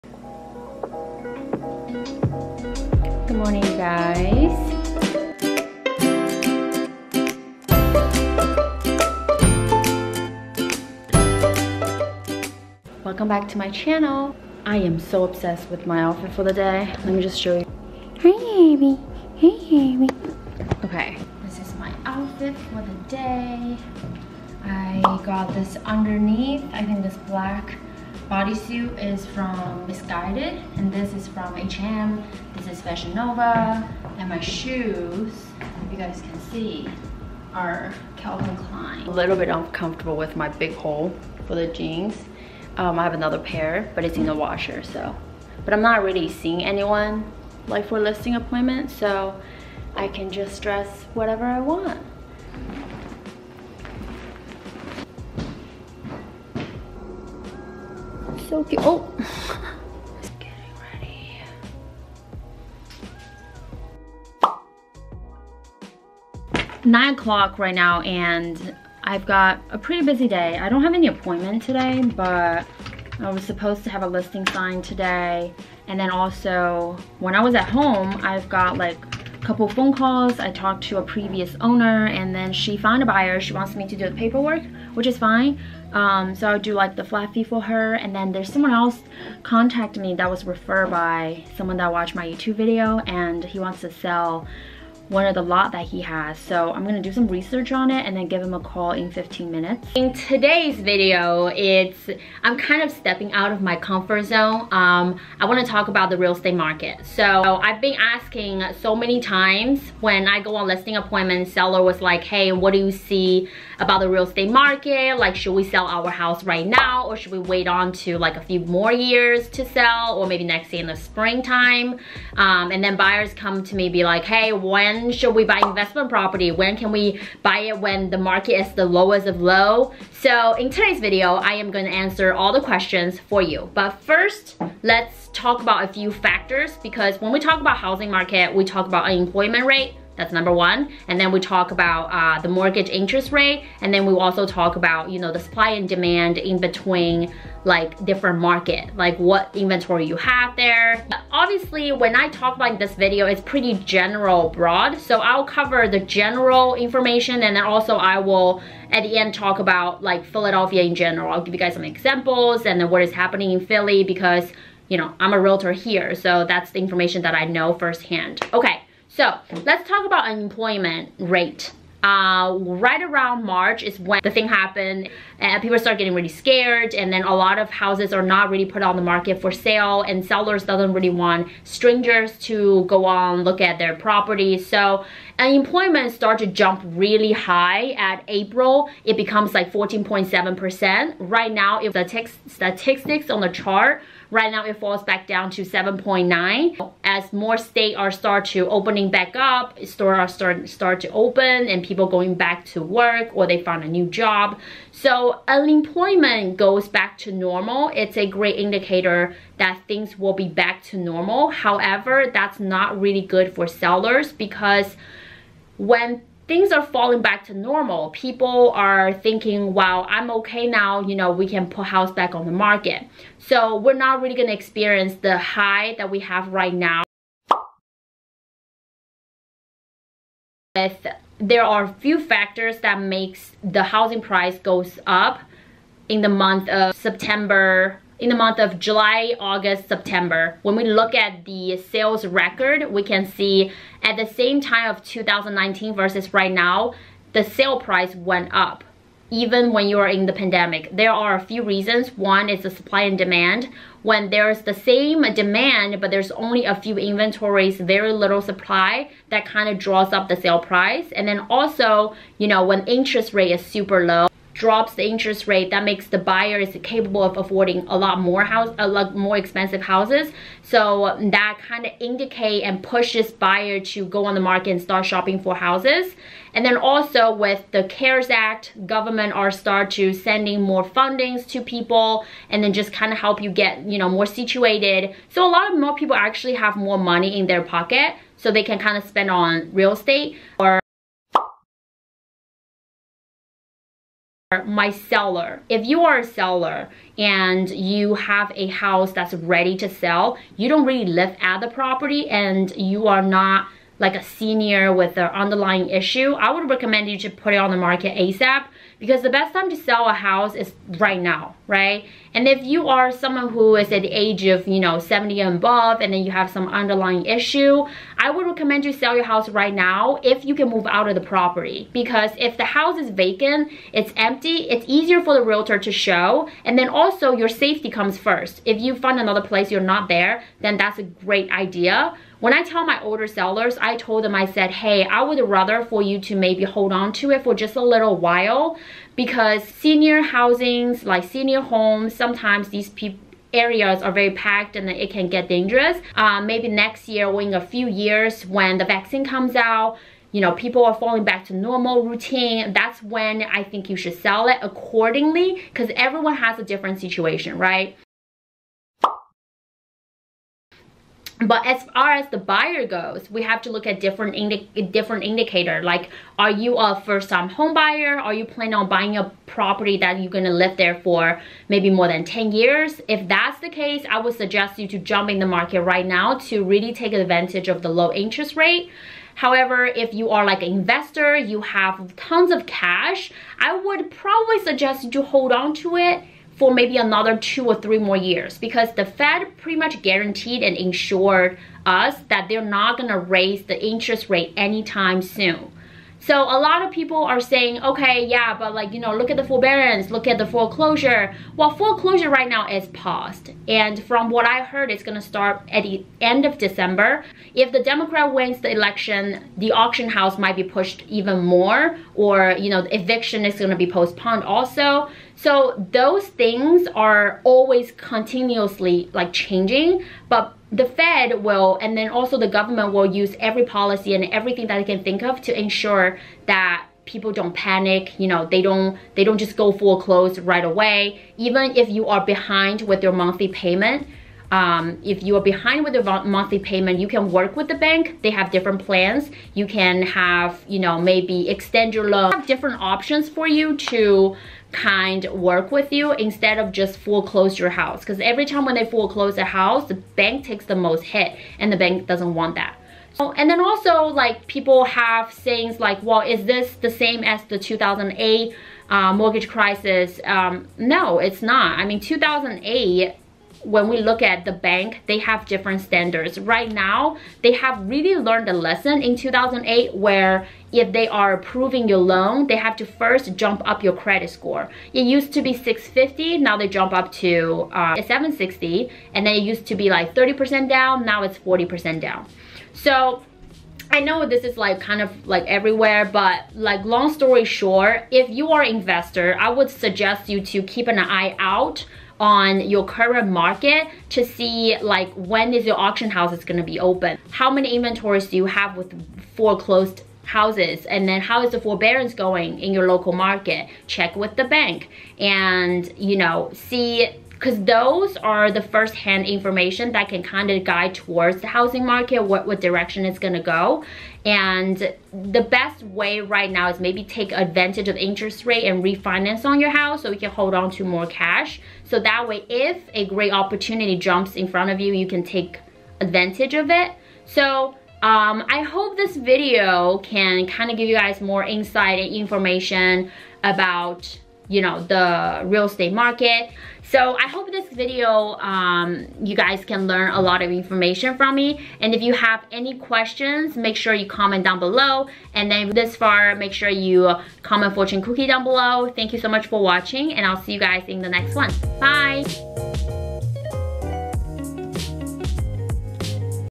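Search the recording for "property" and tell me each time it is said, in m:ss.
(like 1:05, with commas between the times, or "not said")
2:06, 3:03, 5:01, 5:21, 6:09.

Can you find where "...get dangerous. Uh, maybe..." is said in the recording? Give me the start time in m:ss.
5:45.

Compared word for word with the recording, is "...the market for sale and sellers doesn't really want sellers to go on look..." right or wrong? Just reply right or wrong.
wrong.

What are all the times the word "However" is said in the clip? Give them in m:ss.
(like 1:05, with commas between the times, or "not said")
3:31, 6:19.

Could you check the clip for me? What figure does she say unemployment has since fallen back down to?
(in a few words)
7.9.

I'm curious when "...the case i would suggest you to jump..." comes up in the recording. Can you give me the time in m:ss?
6:13.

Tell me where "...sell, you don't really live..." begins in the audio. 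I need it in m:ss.
4:59.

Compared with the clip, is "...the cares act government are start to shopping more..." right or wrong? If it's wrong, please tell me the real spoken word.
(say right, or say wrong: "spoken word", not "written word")
wrong: "sending", not "shopping".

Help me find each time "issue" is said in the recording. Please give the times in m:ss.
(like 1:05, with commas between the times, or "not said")
5:05, 5:17.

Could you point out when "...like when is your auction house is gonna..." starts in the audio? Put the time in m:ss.
8:14.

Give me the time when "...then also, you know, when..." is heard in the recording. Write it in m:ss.
4:21.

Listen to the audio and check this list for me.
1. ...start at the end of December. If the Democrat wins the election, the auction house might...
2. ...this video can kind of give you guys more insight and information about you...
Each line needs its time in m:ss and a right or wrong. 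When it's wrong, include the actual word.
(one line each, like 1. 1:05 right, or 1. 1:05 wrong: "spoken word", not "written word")
1. 6:45 right
2. 8:48 right.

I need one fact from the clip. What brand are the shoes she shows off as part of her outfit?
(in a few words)
Calvin Klein.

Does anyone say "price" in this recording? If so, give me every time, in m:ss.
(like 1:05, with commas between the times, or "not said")
3:54, 4:07, 4:20.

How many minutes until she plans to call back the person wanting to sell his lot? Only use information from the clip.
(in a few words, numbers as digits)
15.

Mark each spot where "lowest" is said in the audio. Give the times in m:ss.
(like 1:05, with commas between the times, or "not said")
2:08.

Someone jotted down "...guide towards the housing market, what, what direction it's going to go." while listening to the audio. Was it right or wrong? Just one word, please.
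right.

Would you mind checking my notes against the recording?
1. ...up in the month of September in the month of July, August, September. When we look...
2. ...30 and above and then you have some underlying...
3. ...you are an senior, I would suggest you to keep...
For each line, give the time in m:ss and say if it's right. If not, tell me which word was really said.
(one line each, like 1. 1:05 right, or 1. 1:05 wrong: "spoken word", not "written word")
1. 3:55 right
2. 5:14 wrong: "70", not "30"
3. 8:08 wrong: "investor", not "senior".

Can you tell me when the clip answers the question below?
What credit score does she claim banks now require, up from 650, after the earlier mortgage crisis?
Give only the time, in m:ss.
7:57.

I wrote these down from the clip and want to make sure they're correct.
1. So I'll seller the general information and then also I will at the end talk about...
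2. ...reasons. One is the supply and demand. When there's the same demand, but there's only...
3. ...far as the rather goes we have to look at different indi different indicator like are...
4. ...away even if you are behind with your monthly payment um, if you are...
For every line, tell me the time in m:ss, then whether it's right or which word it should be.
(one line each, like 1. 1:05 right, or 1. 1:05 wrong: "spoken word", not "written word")
1. 2:34 wrong: "cover", not "seller"
2. 4:11 right
3. 6:01 wrong: "buyer", not "rather"
4. 7:10 right.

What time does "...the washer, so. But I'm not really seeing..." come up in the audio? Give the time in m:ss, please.
0:44.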